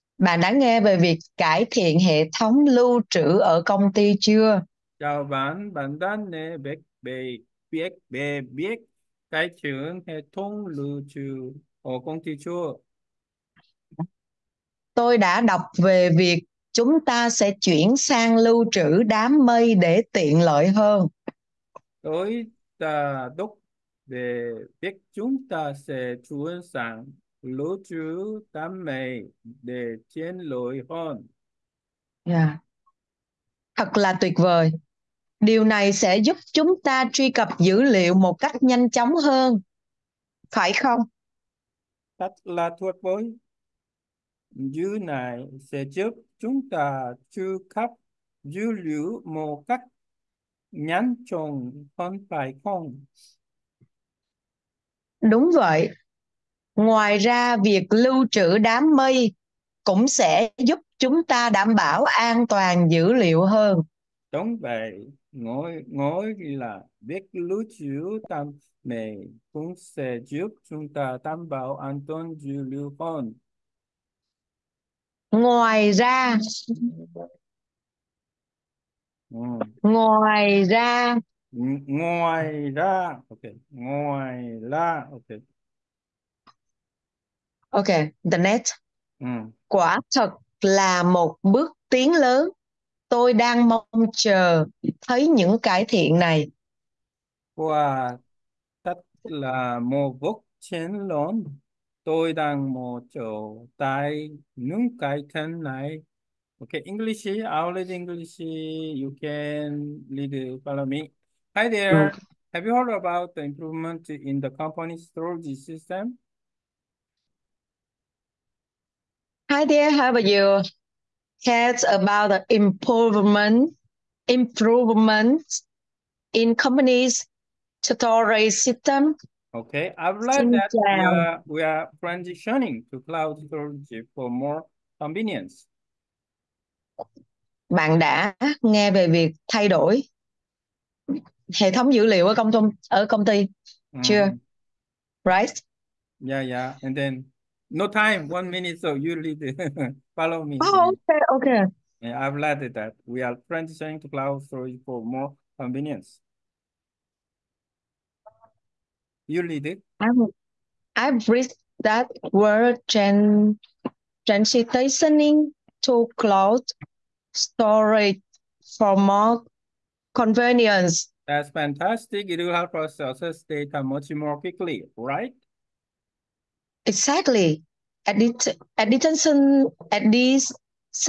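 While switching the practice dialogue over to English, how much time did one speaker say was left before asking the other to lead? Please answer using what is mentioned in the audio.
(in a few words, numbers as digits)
1 minute.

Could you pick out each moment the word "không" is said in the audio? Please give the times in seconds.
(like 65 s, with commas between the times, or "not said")
40 s, 52 s.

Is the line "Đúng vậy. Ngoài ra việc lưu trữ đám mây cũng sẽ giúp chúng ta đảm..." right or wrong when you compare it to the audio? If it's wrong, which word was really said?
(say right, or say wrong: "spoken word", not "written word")
right.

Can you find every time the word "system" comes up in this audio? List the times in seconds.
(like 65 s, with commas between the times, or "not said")
115 s, 128 s.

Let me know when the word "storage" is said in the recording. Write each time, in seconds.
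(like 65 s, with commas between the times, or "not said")
115 s, 127 s, 133 s, 154 s, 167 s.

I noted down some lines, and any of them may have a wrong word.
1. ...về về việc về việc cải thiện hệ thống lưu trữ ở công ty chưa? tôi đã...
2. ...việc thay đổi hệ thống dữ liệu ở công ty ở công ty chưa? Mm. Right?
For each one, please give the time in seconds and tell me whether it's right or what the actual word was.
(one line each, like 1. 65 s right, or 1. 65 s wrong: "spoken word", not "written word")
1. 6 s right
2. 139 s right.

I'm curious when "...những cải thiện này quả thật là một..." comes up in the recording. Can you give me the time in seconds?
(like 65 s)
95 s.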